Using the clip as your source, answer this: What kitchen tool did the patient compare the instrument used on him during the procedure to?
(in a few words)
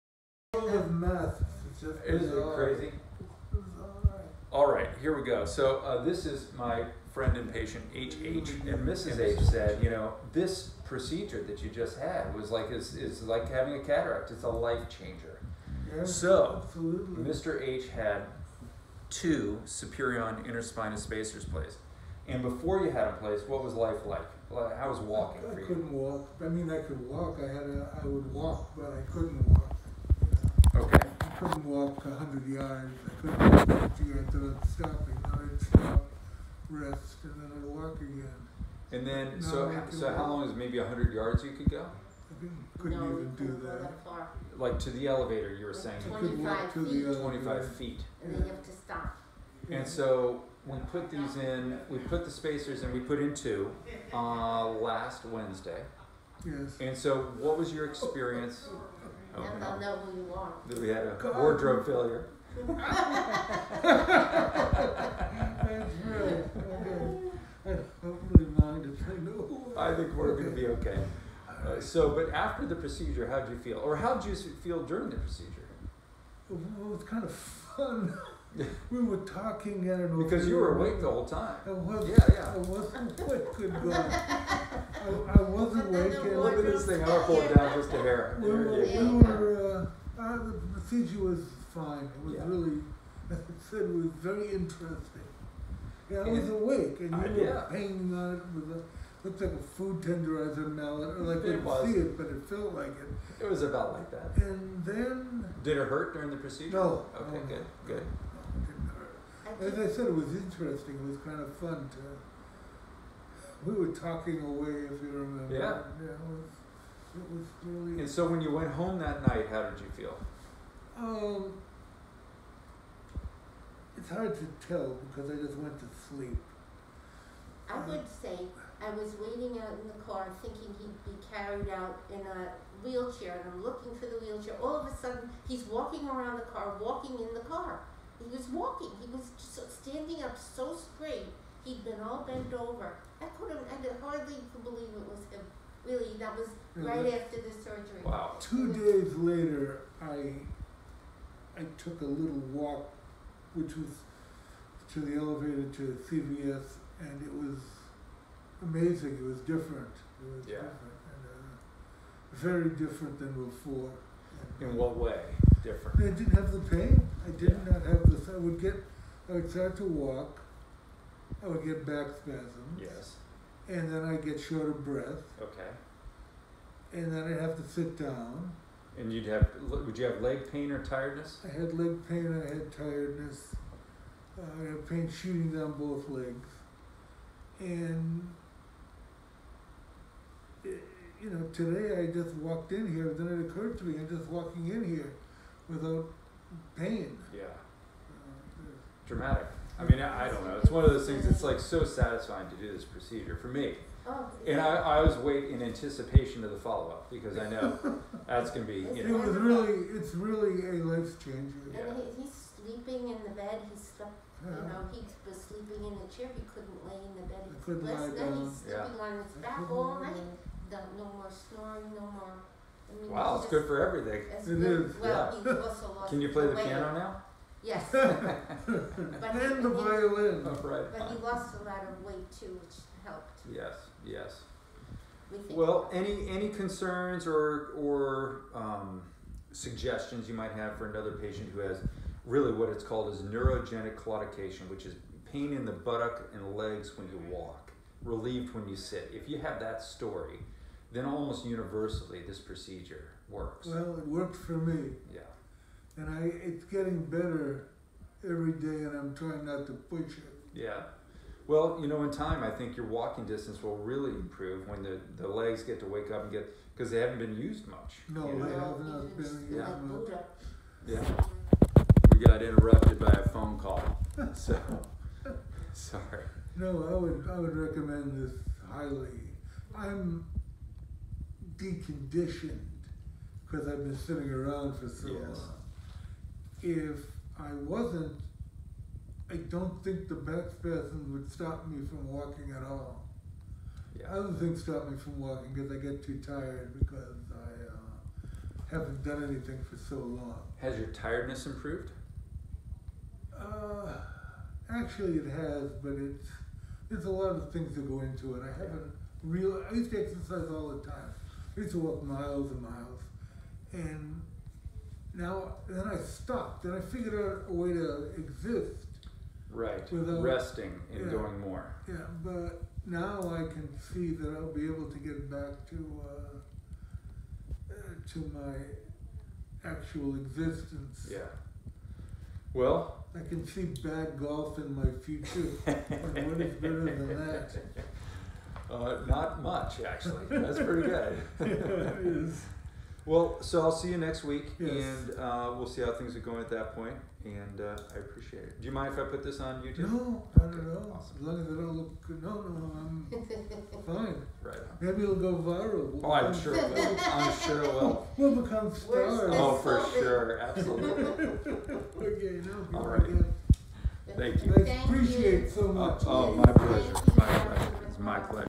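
Food tenderizer mallet.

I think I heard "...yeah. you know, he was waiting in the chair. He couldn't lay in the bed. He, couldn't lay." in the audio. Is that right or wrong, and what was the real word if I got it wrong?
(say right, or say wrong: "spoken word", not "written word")
wrong: "sleeping", not "waiting".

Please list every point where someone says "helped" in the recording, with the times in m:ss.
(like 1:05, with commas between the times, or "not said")
3:53.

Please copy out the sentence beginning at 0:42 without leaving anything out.
I couldn't no, even do that.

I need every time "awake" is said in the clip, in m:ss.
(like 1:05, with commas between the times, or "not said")
1:20, 1:25, 1:36.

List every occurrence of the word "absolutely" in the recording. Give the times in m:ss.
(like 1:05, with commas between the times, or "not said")
0:16, 6:00.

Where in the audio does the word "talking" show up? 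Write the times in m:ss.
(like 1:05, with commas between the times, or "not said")
1:19, 1:53.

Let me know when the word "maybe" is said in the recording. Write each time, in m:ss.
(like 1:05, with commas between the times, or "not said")
0:40, 5:54.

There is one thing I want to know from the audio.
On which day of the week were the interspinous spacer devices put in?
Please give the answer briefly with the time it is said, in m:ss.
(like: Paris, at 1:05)
Wednesday, at 0:54.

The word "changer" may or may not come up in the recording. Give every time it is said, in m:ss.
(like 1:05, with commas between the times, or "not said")
0:14, 3:31.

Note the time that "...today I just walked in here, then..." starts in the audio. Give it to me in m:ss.
3:11.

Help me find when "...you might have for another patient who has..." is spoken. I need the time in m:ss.
4:00.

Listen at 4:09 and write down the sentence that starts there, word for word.
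If you have that story, then almost universally this procedure works.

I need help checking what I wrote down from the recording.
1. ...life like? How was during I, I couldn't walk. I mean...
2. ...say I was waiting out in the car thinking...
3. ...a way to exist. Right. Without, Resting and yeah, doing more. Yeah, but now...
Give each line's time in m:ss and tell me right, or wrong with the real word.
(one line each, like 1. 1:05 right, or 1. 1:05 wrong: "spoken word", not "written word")
1. 0:23 wrong: "walking", not "during"
2. 2:08 right
3. 5:17 right.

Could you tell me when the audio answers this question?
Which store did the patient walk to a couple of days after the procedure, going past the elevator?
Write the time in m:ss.
2:36.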